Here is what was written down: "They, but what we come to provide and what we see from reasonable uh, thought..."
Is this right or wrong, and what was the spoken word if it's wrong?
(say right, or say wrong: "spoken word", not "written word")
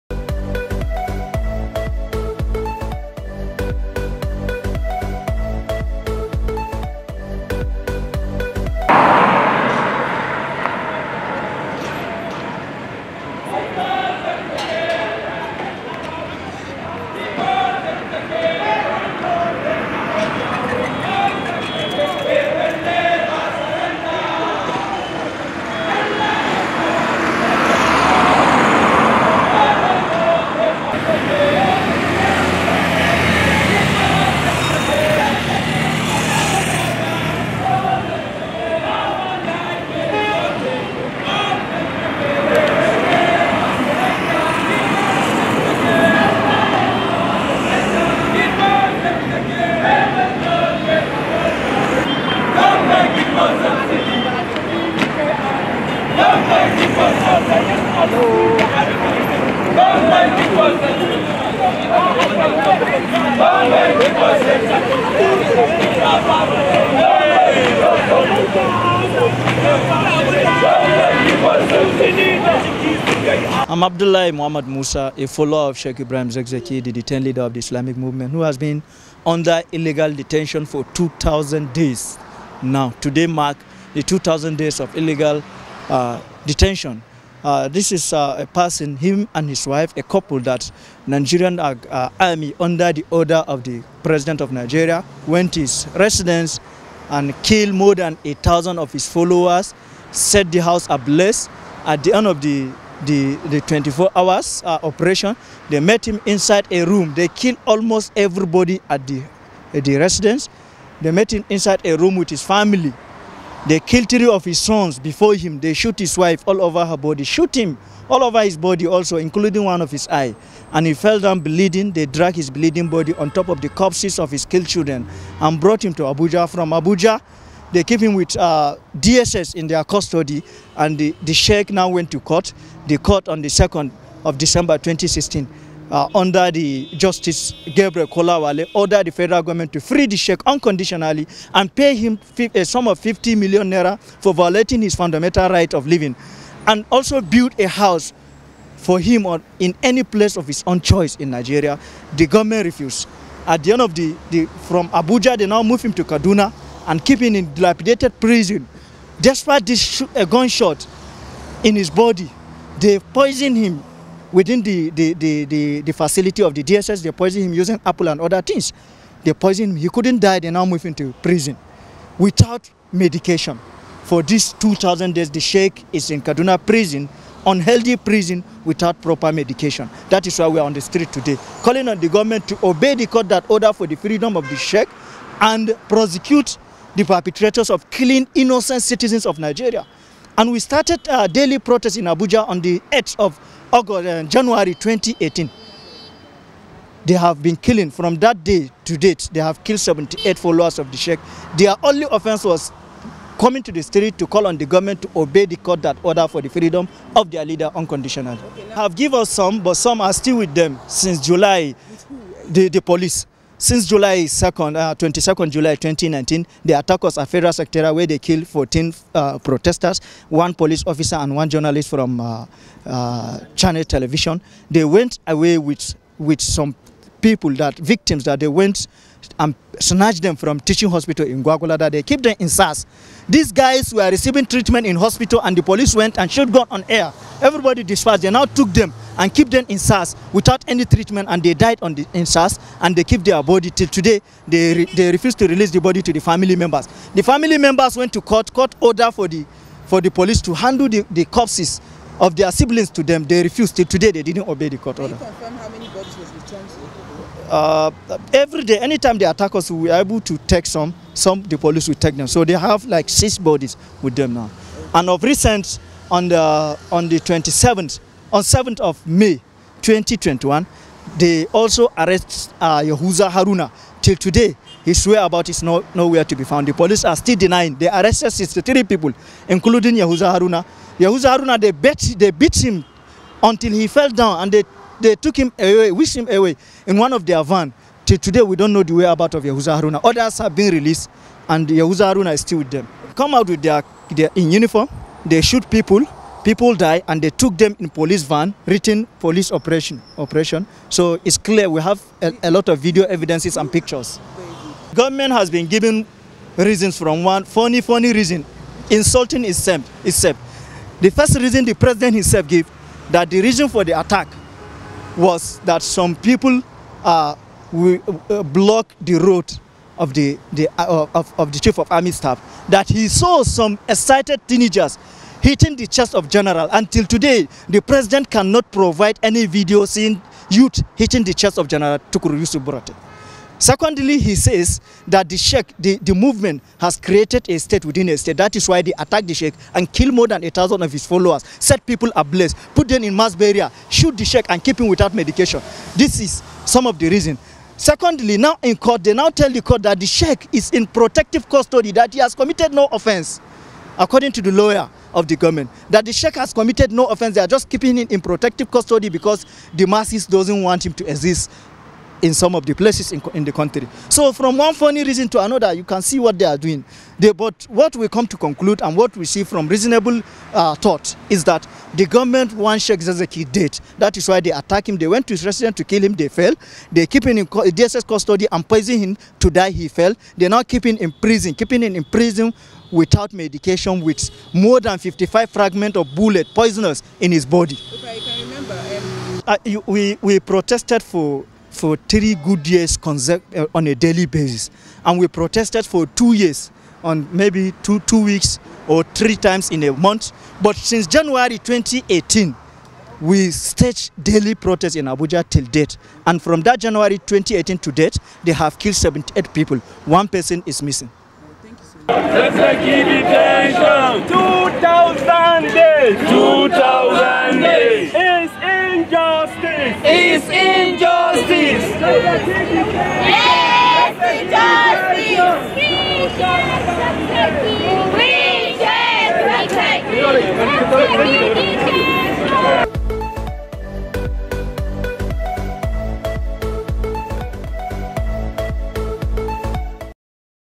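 wrong: "conclude", not "provide".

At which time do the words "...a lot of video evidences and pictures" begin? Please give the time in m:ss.
5:02.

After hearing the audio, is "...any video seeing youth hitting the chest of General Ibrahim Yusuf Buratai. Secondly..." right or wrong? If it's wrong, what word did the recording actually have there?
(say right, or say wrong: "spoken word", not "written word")
wrong: "Tukuru", not "Ibrahim".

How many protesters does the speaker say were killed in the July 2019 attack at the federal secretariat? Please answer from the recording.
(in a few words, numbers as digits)
14.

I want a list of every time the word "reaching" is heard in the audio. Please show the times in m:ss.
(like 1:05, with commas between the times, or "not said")
not said.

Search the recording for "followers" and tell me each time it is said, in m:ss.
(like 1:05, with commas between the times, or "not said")
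1:15, 1:39, 3:20, 5:41.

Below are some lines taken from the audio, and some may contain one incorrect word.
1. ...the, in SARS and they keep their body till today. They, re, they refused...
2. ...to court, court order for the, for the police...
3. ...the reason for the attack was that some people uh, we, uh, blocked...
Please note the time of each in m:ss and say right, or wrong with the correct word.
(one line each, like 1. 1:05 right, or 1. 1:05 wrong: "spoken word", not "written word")
1. 4:01 right
2. 4:08 right
3. 5:13 right.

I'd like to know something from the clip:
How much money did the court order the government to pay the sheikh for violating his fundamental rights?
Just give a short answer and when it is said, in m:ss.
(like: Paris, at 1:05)
50 million naira, at 2:22.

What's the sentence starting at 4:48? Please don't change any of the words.
Till today, we don't know the way about of Yahuza Haruna.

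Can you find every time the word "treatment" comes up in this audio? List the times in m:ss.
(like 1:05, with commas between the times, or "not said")
3:54, 4:00.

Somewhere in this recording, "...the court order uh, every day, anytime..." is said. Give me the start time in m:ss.
4:14.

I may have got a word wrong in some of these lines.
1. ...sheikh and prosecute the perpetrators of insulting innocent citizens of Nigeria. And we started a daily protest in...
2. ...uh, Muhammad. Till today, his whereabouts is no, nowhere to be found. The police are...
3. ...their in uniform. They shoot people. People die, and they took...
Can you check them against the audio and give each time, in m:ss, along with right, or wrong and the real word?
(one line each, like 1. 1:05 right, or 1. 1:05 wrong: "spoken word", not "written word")
1. 3:04 wrong: "killing", not "insulting"
2. 4:32 wrong: "Haruna", not "Muhammad"
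3. 4:54 right.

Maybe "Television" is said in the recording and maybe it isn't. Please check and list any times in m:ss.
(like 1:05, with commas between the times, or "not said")
3:43.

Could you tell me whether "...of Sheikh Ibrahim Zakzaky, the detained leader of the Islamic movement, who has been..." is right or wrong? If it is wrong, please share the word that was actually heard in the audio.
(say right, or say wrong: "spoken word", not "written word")
right.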